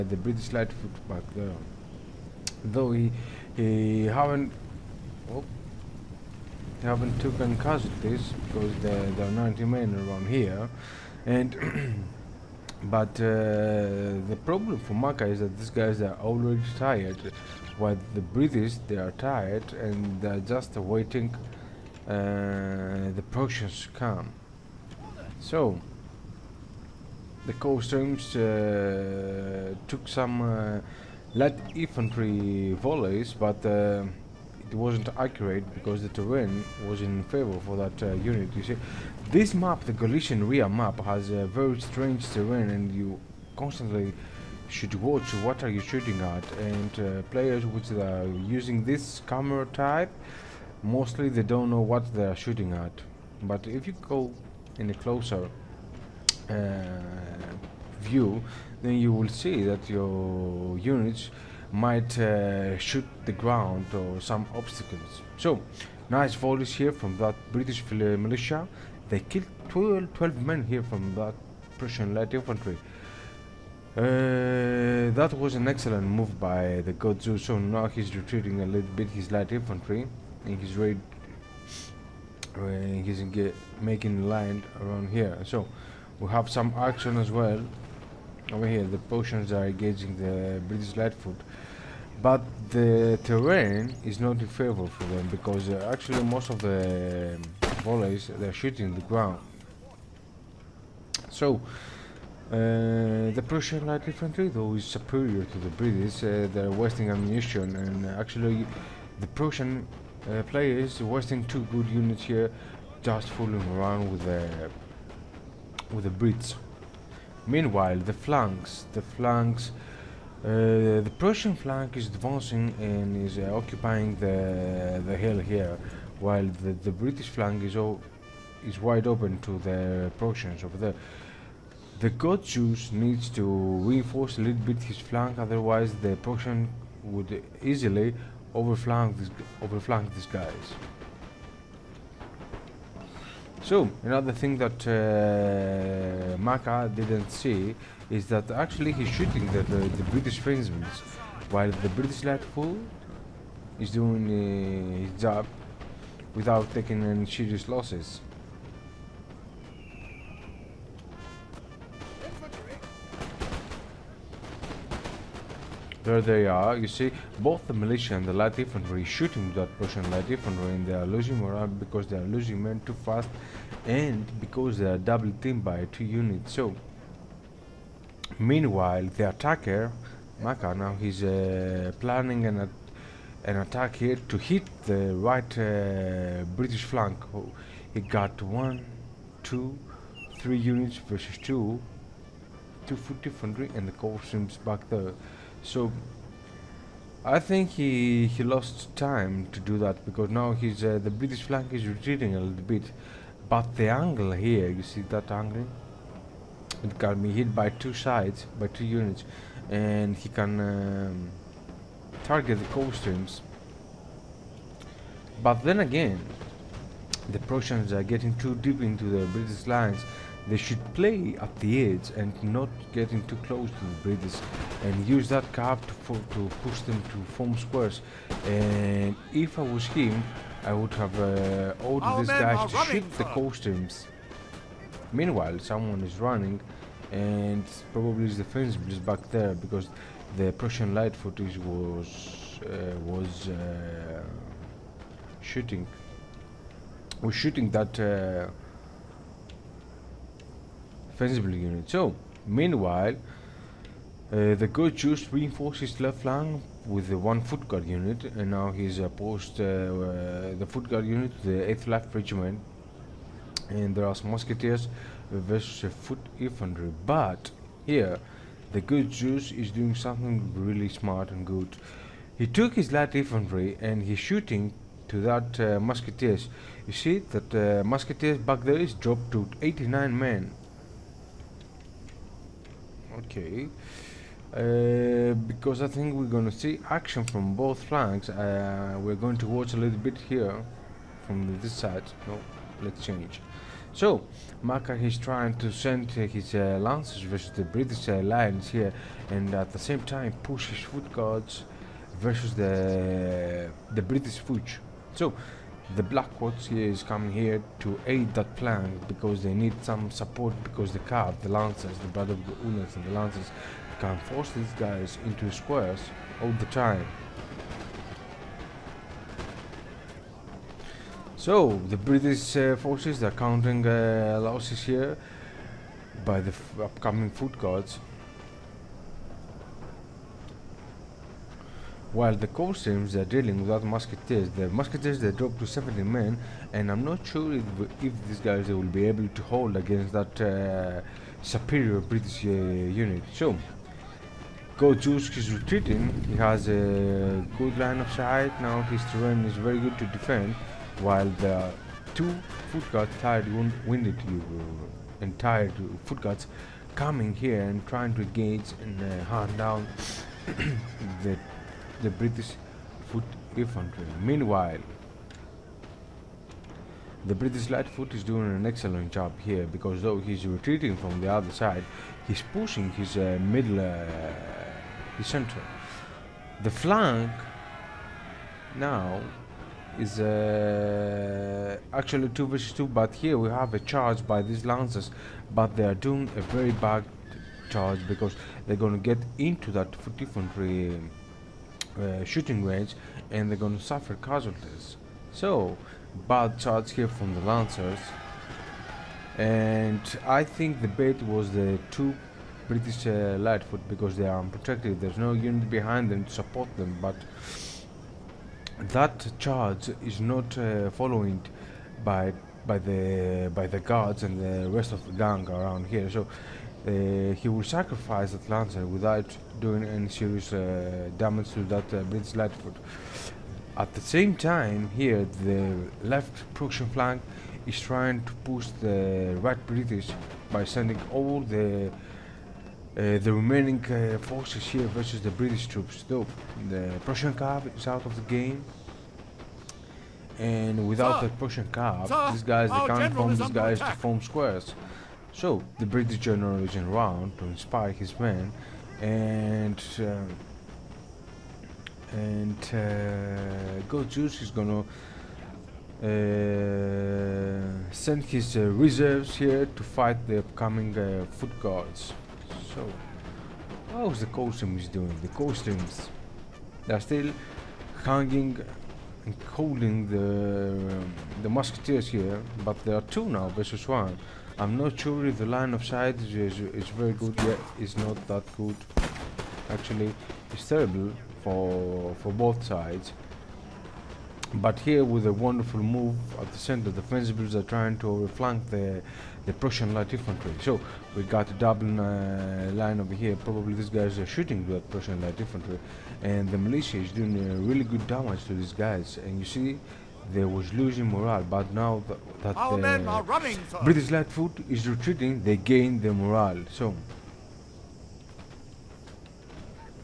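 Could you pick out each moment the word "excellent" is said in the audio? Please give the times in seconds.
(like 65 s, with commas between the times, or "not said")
75 s, 368 s.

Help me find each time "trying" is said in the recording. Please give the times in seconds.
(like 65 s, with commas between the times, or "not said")
295 s, 357 s, 427 s, 487 s.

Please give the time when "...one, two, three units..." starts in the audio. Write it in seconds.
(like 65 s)
188 s.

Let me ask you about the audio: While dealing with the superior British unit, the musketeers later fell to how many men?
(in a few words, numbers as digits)
70.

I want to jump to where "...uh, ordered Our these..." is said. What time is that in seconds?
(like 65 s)
231 s.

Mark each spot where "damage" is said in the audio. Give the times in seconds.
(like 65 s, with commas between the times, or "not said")
421 s, 498 s.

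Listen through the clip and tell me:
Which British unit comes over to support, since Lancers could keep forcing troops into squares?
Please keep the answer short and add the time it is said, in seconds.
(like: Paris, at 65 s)
Black Watch, at 305 s.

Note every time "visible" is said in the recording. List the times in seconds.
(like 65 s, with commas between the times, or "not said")
not said.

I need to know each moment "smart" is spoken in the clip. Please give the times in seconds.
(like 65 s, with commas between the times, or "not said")
270 s.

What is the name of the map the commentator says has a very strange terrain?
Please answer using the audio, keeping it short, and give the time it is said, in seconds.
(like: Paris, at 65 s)
Galician Ria, at 39 s.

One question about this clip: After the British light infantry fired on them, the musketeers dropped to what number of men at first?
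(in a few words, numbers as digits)
89.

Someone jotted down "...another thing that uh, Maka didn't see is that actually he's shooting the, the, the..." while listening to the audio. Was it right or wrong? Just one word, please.
right.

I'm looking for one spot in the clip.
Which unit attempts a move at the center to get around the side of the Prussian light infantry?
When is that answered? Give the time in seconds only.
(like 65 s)
486 s.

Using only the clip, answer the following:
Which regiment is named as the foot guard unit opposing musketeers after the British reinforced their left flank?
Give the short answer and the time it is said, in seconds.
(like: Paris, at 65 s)
8th Life Regiment, at 261 s.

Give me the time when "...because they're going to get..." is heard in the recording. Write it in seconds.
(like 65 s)
388 s.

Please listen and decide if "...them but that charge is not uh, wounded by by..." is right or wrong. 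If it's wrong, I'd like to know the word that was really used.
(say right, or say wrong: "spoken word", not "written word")
wrong: "followed", not "wounded".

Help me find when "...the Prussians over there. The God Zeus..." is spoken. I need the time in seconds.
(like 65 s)
129 s.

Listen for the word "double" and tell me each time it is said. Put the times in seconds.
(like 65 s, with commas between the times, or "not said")
174 s, 491 s.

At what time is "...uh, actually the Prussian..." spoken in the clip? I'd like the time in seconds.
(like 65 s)
108 s.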